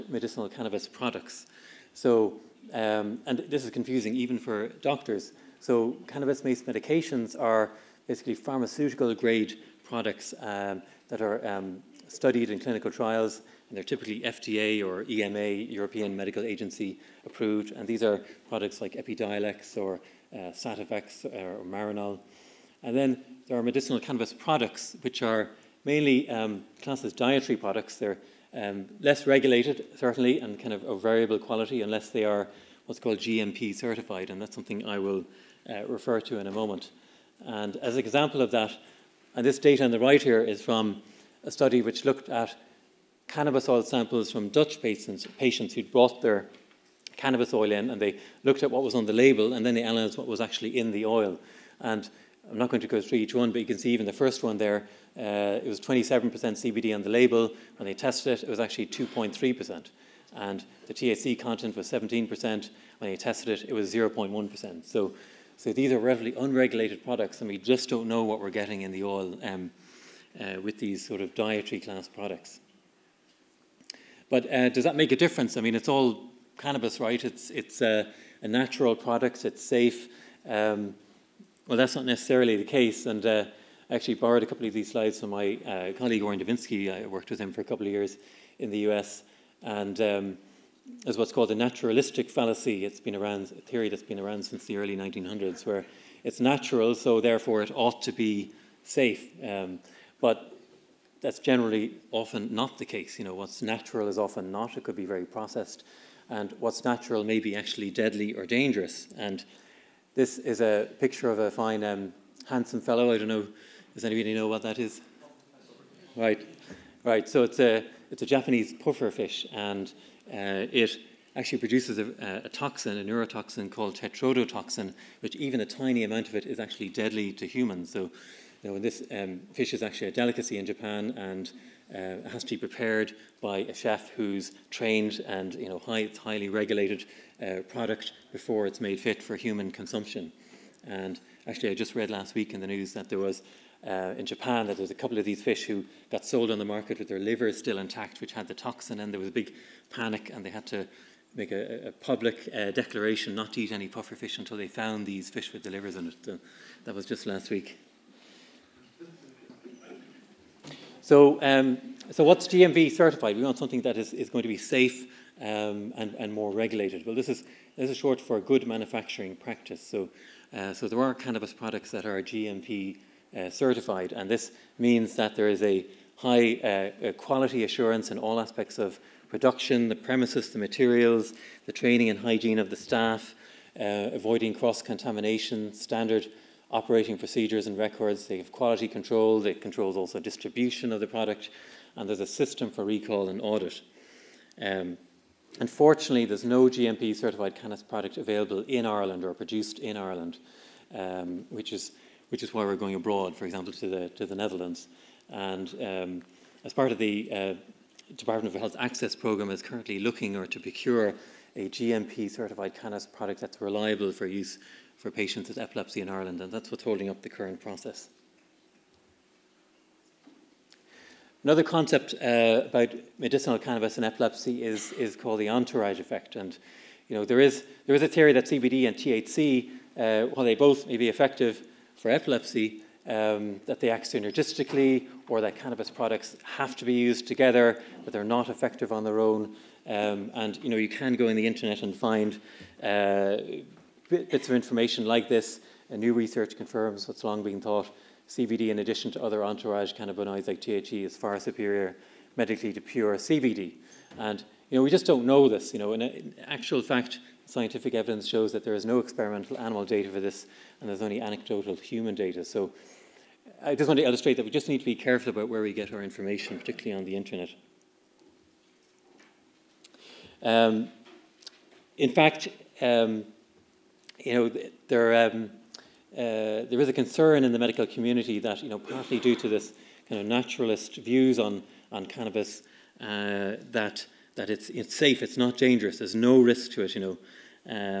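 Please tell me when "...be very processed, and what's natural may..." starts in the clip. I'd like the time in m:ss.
1:44.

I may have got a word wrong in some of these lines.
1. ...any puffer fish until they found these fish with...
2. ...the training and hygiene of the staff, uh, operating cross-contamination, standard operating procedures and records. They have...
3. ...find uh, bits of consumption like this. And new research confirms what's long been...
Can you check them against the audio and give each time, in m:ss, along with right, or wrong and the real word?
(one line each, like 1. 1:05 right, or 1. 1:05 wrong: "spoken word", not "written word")
1. 2:33 right
2. 3:01 wrong: "avoiding", not "operating"
3. 4:01 wrong: "information", not "consumption".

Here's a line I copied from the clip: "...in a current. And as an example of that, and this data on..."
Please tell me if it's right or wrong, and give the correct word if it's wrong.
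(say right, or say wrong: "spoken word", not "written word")
wrong: "moment", not "current".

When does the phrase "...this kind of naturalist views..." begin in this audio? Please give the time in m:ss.
4:39.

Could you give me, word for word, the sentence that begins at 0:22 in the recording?
And then there are medicinal cannabis products, which are mainly um, classed as dietary products.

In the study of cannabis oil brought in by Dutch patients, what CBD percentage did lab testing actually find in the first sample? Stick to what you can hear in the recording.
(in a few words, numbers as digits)
2.3%.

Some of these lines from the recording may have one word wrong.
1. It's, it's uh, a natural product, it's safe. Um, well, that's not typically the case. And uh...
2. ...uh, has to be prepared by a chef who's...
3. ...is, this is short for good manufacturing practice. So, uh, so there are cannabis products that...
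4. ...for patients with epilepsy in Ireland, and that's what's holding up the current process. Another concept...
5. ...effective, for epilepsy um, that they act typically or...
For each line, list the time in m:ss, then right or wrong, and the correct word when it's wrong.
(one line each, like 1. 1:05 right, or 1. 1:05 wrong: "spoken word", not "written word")
1. 1:17 wrong: "necessarily", not "typically"
2. 2:11 right
3. 2:47 right
4. 3:34 right
5. 3:51 wrong: "synergistically", not "typically".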